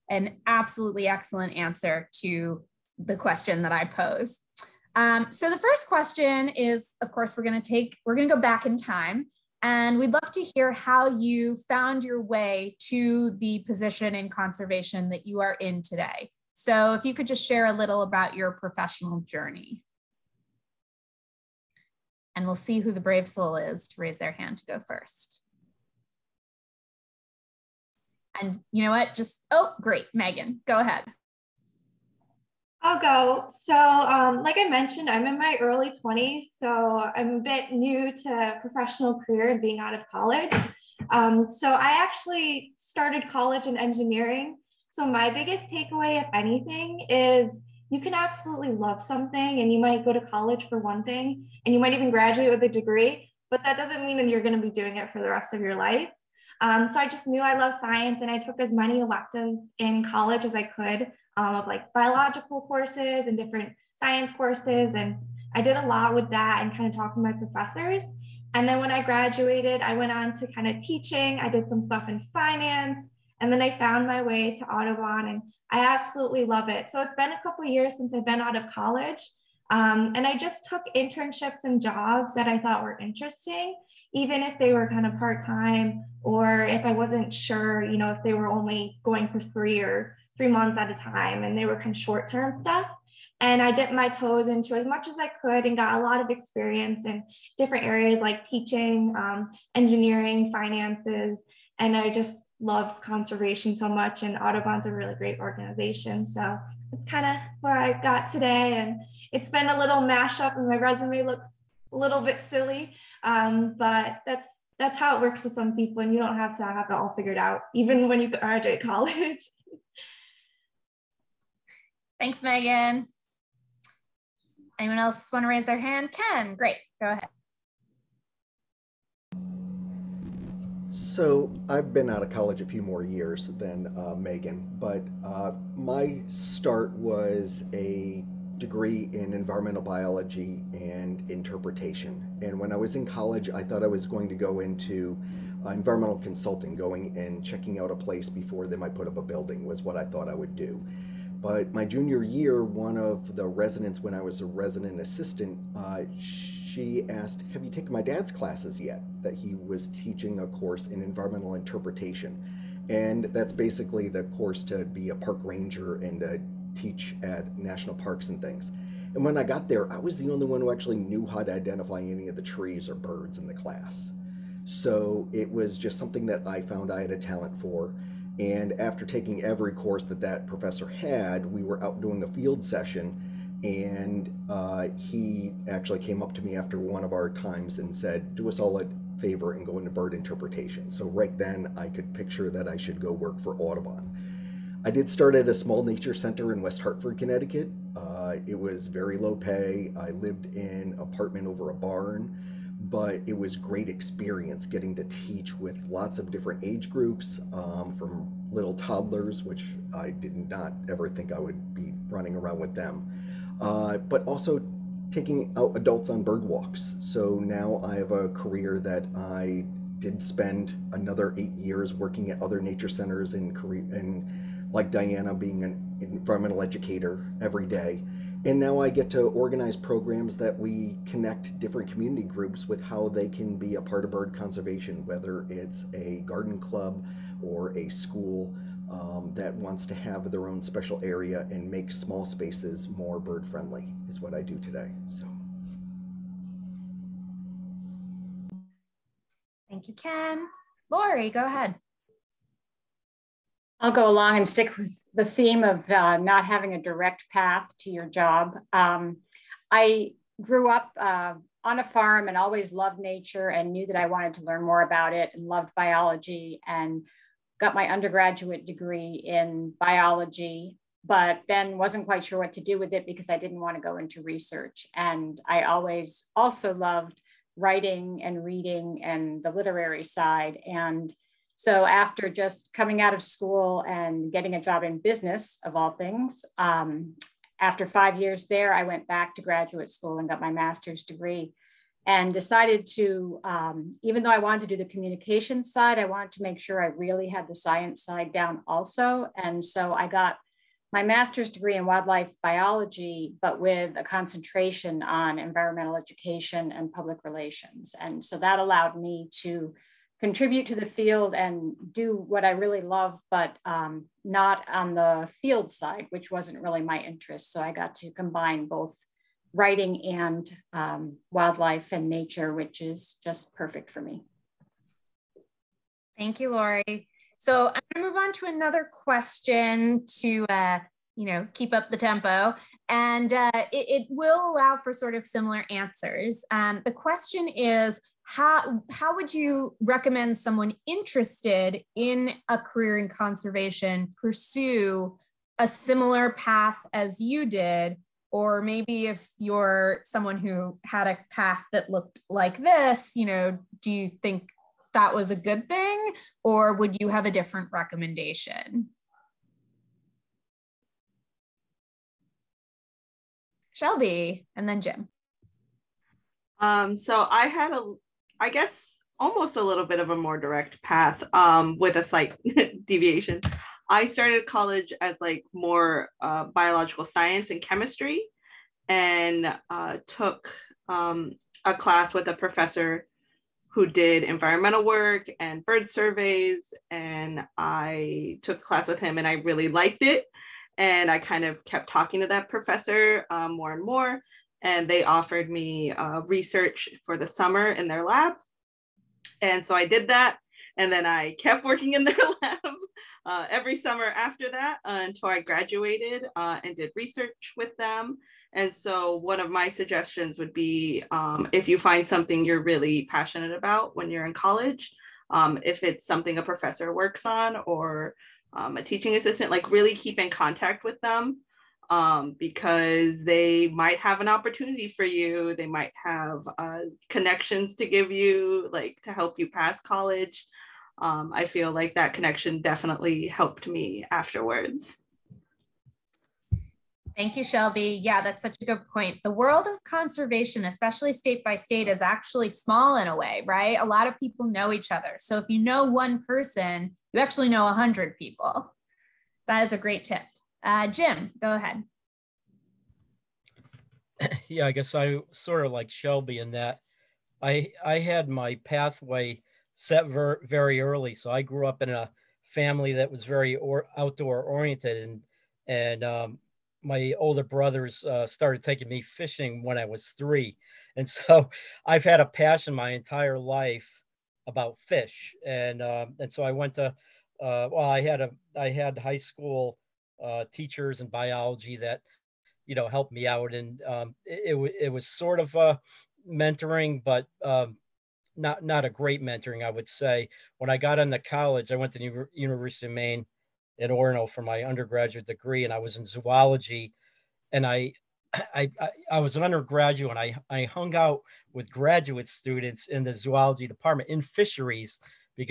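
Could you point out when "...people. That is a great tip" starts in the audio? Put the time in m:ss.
7:28.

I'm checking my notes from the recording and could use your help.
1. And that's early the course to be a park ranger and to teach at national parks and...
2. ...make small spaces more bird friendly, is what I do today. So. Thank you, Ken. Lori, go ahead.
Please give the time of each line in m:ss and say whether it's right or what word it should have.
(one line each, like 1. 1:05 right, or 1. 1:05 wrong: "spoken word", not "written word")
1. 2:42 wrong: "basically", not "early"
2. 4:01 right.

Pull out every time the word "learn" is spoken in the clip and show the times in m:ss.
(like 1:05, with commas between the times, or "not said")
4:24.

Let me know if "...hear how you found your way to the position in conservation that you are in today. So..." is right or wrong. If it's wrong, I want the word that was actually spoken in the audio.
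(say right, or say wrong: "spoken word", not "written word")
right.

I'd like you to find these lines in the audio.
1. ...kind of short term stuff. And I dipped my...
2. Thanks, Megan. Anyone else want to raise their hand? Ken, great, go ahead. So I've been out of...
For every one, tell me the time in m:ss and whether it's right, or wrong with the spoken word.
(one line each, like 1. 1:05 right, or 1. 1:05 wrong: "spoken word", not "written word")
1. 1:31 right
2. 2:02 right.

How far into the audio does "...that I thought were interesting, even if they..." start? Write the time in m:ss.
1:22.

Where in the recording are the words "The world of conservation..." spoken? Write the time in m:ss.
7:19.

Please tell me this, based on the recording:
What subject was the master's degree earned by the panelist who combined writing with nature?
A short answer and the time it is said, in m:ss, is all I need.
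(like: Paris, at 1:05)
wildlife biology, at 5:01.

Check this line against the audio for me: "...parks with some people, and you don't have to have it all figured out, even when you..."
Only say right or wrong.
wrong.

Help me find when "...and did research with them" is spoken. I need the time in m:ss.
6:46.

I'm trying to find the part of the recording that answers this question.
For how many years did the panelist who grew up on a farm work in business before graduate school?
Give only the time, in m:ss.
4:47.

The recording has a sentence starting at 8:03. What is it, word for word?
And um, it, it, it, was sort of uh, mentoring, but um, not, not a great mentoring, I would say.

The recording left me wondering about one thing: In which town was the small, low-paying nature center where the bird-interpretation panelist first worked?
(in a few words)
West Hartford, Connecticut.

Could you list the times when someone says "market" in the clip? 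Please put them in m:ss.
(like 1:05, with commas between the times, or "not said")
not said.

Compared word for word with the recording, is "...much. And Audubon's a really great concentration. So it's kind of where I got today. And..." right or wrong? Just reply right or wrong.
wrong.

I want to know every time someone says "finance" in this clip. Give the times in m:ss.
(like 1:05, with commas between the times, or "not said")
1:12, 1:40.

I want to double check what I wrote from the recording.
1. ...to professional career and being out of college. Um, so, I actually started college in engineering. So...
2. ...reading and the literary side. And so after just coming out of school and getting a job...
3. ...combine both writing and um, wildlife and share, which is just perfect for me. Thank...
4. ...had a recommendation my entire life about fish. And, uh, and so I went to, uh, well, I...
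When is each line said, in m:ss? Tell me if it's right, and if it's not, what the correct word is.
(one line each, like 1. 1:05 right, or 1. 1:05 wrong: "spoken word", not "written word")
1. 0:38 right
2. 4:38 right
3. 5:18 wrong: "nature", not "share"
4. 7:52 wrong: "passion", not "recommendation".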